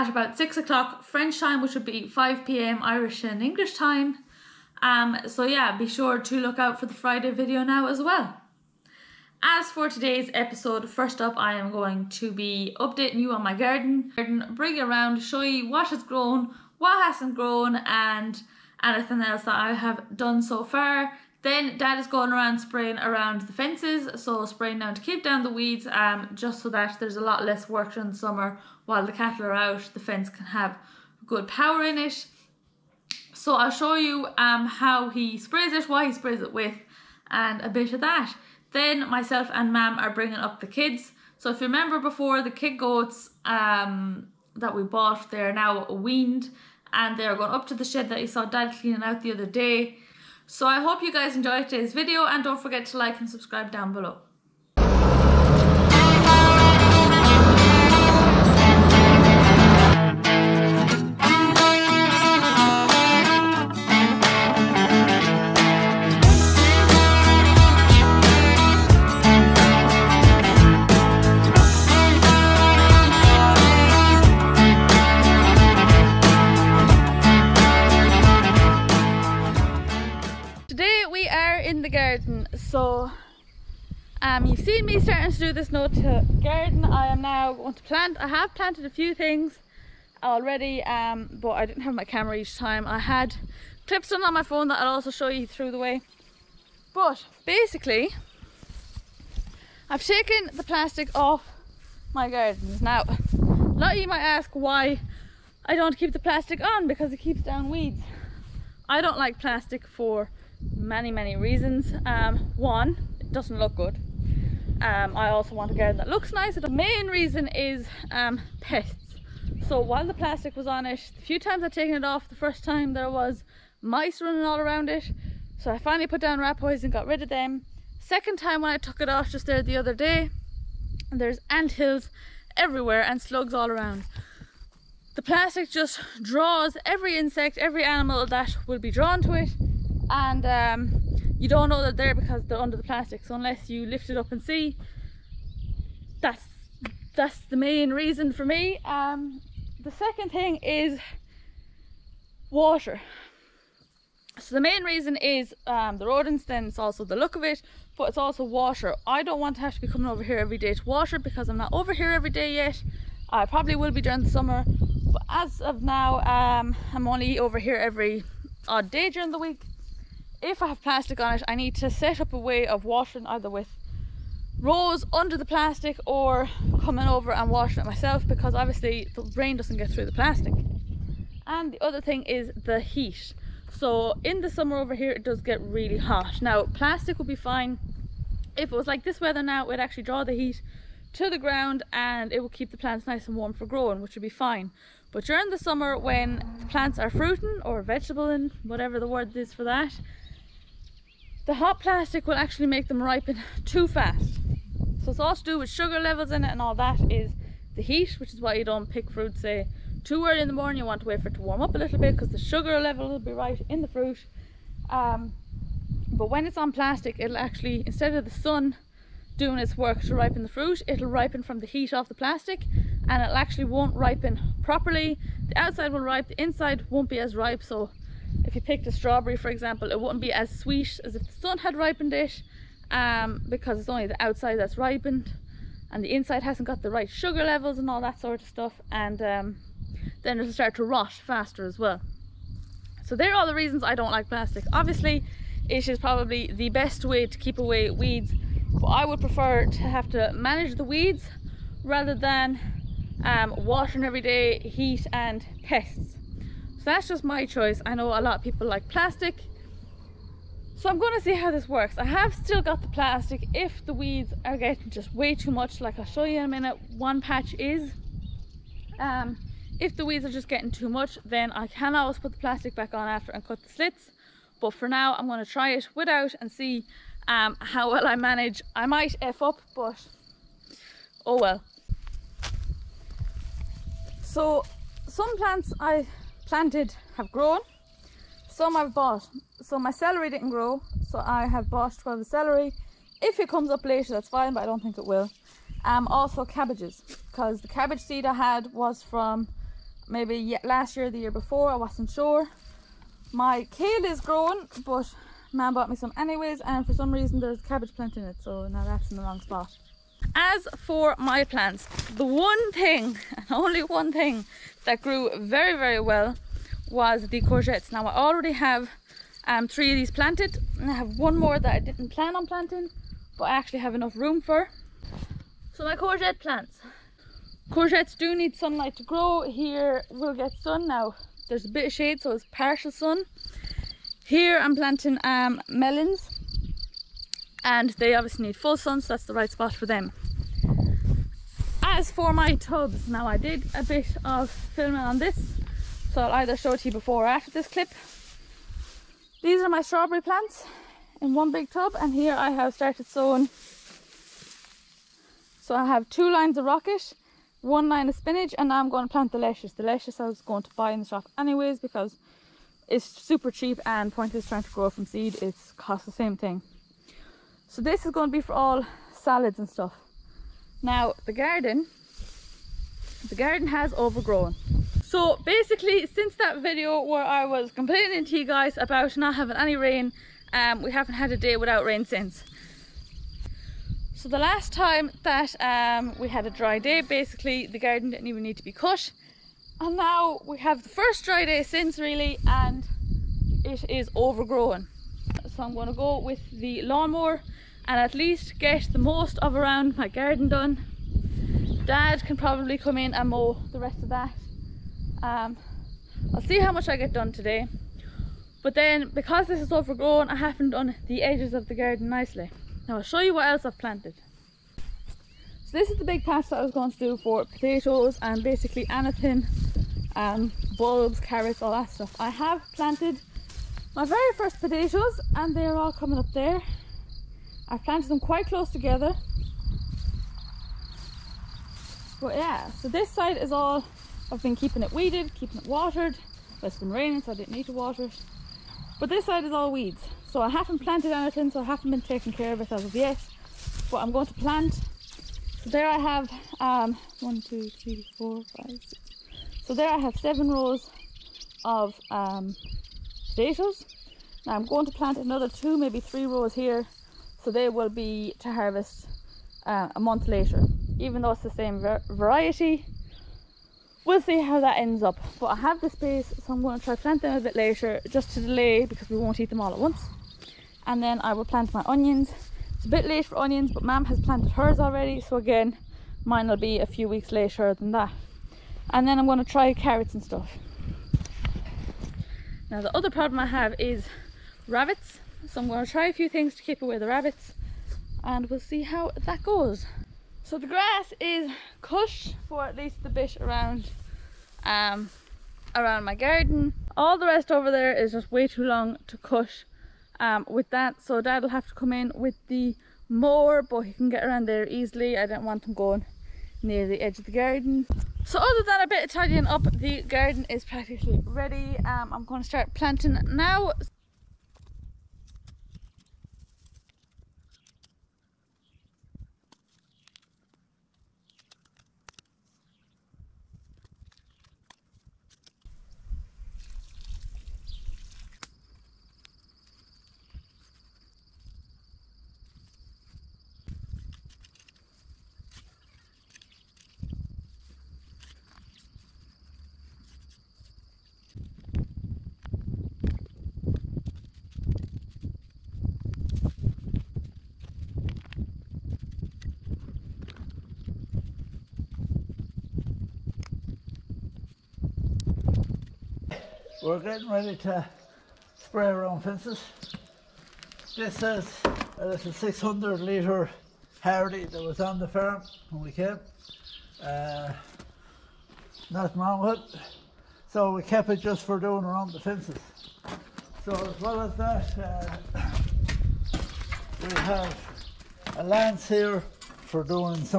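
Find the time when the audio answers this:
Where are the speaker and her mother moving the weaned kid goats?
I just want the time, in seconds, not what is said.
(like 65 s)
47 s.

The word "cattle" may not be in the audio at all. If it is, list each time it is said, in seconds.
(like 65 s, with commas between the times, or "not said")
29 s.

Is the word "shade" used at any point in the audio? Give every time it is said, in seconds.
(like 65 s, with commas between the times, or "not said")
331 s.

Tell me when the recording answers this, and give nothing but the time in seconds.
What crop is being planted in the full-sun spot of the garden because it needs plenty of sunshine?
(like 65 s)
335 s.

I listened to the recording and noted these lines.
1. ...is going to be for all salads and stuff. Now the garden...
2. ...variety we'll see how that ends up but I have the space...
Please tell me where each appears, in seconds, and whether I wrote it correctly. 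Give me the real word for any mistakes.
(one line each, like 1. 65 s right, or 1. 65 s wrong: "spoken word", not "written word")
1. 368 s right
2. 462 s right.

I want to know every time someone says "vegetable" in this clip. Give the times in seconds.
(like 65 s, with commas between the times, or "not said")
197 s.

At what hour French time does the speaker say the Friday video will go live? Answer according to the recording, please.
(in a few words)
6 o'clock.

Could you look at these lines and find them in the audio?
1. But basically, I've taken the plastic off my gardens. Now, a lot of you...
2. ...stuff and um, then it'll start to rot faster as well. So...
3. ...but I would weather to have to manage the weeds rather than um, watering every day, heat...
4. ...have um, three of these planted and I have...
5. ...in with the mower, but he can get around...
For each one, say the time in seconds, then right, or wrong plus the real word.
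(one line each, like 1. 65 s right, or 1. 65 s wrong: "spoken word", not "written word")
1. 96 s right
2. 238 s right
3. 248 s wrong: "prefer", not "weather"
4. 318 s right
5. 501 s right.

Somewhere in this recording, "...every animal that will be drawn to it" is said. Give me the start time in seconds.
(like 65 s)
137 s.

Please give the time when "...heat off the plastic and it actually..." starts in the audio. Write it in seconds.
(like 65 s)
221 s.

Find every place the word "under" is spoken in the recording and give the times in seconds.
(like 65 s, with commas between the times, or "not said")
142 s, 175 s.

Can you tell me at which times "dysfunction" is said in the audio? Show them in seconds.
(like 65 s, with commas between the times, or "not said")
not said.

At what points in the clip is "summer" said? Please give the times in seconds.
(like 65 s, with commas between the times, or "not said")
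28 s, 164 s, 184 s, 195 s.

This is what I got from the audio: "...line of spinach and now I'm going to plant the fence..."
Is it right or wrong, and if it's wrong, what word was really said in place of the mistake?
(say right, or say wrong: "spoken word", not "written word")
wrong: "lettuce", not "fence".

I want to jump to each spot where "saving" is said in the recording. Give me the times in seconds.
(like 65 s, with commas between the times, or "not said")
not said.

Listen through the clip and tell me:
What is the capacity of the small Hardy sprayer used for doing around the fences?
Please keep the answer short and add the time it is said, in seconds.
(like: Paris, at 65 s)
600 litres, at 562 s.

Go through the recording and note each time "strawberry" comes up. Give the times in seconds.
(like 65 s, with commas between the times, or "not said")
228 s, 349 s.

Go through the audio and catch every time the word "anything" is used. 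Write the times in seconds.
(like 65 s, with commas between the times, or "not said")
18 s, 418 s, 441 s.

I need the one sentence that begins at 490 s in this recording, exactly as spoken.
So the grass is cush for at least the bit around um, around my garden.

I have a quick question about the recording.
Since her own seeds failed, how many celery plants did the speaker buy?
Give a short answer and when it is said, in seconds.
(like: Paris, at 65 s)
12, at 291 s.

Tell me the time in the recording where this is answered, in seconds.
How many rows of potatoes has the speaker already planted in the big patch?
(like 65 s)
450 s.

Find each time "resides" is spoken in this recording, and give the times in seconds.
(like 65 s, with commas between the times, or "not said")
not said.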